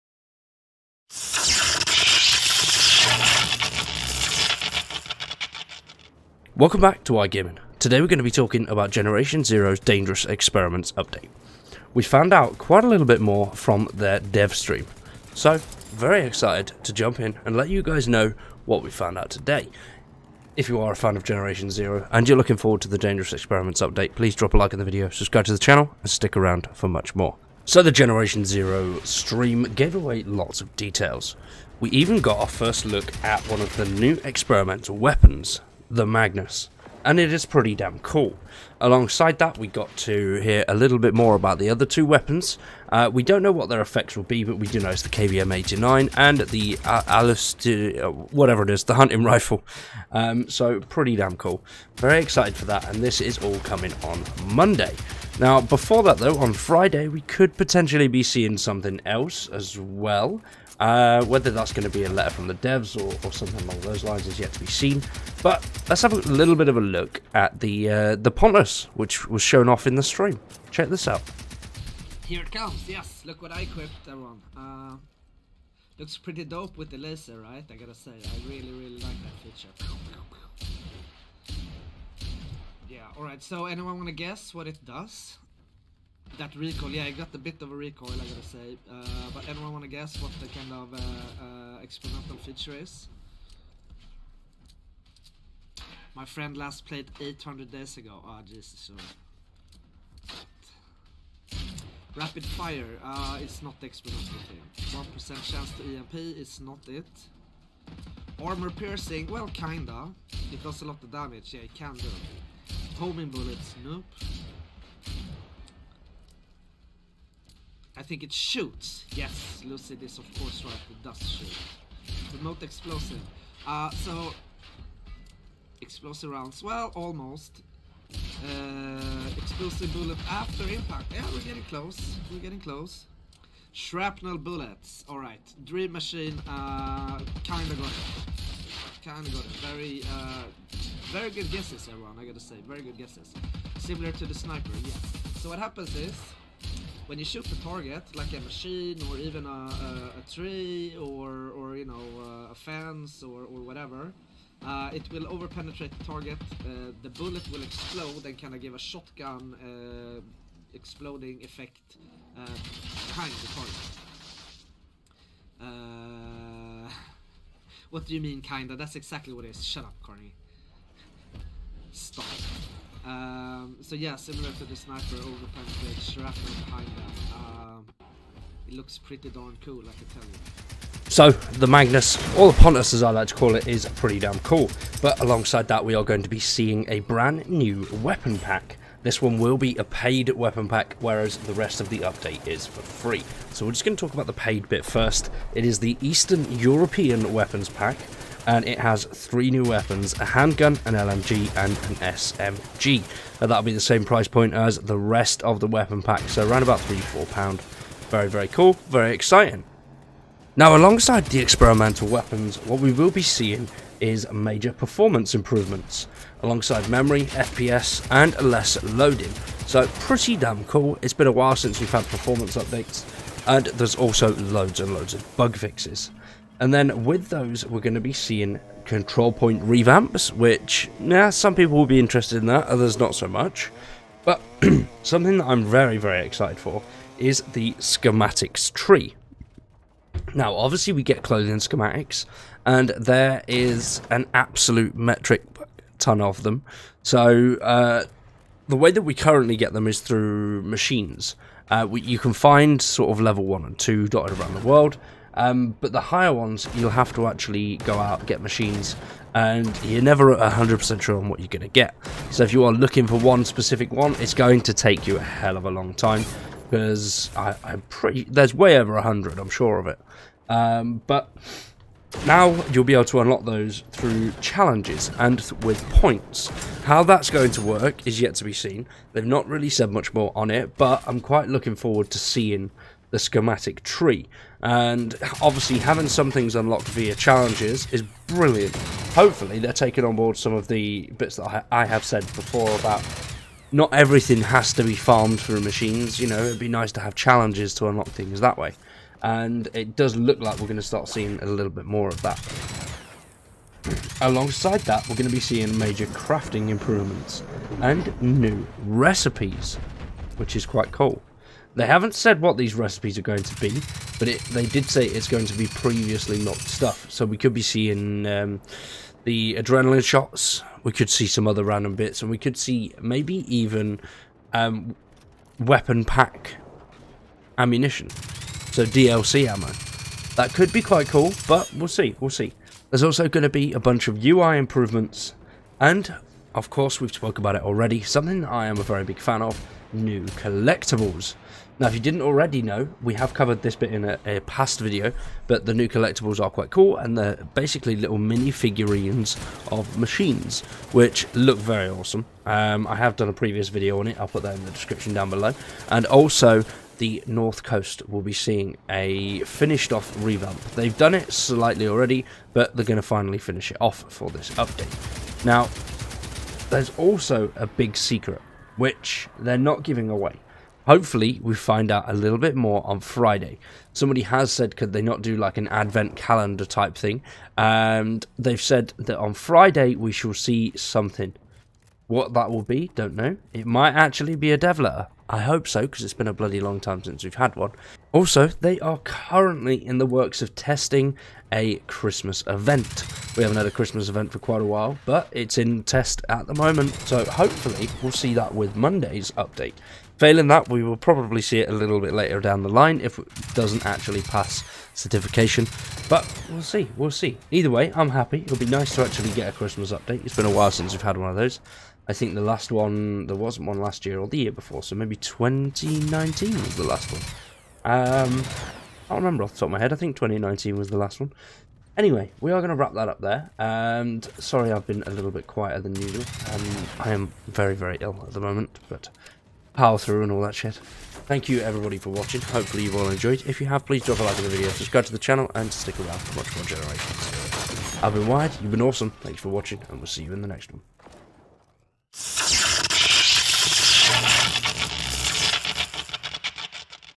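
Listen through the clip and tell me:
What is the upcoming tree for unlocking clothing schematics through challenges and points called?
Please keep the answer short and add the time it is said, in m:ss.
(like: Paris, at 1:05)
schematics tree, at 3:57.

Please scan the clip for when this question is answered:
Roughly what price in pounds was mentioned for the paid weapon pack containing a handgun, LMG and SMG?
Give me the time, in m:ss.
3:26.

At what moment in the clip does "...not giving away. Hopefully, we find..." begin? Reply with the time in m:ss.
6:09.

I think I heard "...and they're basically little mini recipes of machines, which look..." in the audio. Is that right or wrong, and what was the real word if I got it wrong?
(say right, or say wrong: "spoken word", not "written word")
wrong: "figurines", not "recipes".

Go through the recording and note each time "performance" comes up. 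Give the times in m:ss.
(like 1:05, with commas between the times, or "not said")
3:34, 3:42.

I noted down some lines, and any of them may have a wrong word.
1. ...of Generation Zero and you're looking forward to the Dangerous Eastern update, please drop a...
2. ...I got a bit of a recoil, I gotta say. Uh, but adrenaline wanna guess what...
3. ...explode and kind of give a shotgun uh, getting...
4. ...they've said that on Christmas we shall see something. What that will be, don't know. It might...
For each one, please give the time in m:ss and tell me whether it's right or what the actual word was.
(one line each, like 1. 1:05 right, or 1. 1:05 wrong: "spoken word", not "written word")
1. 0:21 wrong: "Experiments", not "Eastern"
2. 1:27 wrong: "anyone", not "adrenaline"
3. 2:37 wrong: "exploding", not "getting"
4. 6:18 wrong: "Friday", not "Christmas".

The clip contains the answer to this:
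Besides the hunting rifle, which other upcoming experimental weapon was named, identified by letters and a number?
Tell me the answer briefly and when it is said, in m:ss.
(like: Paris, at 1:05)
KVM-89, at 0:45.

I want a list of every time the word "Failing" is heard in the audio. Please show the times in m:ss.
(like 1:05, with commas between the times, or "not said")
6:40.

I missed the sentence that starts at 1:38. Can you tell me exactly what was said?
Ah, oh, Jesus, Rapid fire, uh, it's not the experimental thing.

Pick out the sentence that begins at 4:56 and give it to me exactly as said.
You know, it'd be nice to have challenges to unlock things that way.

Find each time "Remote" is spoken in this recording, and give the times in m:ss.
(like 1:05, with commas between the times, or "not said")
2:02.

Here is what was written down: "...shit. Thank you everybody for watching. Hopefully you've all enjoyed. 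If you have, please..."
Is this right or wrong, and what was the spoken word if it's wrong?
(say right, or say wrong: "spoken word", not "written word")
right.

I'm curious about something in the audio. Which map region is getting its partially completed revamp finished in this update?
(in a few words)
North Coast.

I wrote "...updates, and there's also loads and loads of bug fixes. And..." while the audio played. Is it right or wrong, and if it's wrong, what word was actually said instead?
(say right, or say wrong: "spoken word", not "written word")
right.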